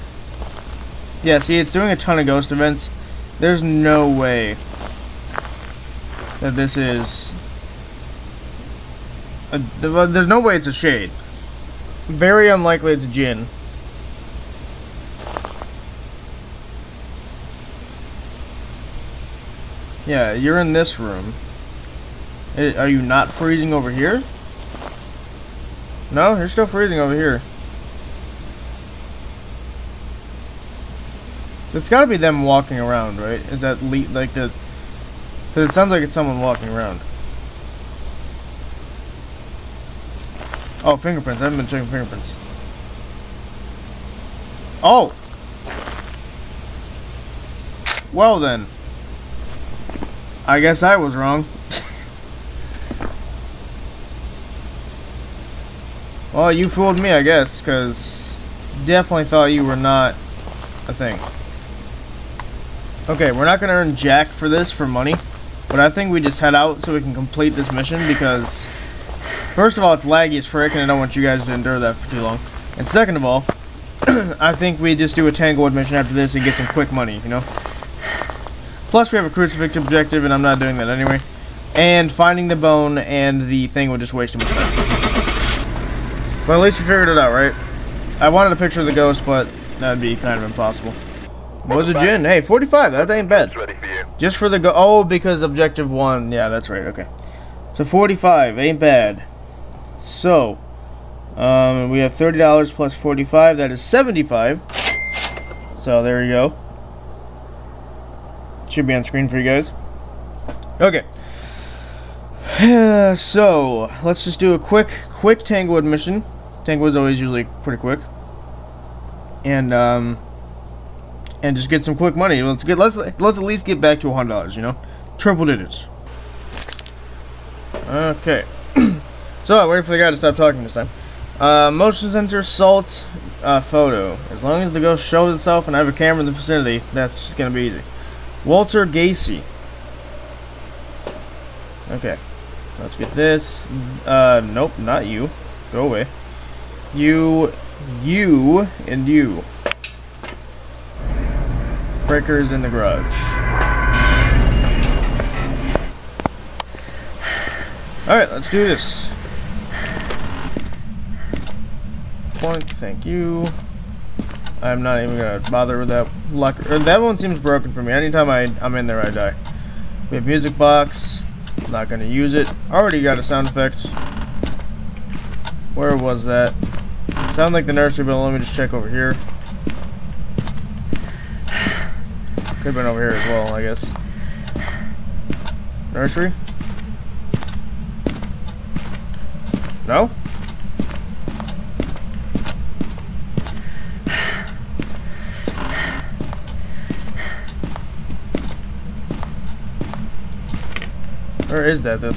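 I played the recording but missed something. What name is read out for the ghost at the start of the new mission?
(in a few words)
Walter Gacy.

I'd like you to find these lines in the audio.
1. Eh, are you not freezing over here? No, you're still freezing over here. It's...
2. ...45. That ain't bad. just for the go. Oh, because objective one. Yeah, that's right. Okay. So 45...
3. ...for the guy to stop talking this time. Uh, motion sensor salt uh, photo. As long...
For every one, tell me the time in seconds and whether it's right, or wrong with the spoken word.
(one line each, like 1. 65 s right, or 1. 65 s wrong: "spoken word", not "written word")
1. 22 s right
2. 92 s right
3. 129 s right.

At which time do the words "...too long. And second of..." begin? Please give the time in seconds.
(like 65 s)
72 s.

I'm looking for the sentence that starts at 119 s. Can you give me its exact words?
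And, um, and just get some quick money.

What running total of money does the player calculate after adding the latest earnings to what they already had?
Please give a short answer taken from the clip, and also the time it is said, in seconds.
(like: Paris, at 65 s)
$75, at 103 s.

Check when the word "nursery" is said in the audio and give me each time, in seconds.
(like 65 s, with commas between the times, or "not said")
177 s, 185 s.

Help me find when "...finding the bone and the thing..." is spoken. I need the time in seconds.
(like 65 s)
82 s.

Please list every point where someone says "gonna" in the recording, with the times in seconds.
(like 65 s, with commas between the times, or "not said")
165 s, 171 s.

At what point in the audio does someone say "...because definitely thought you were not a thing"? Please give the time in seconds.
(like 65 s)
57 s.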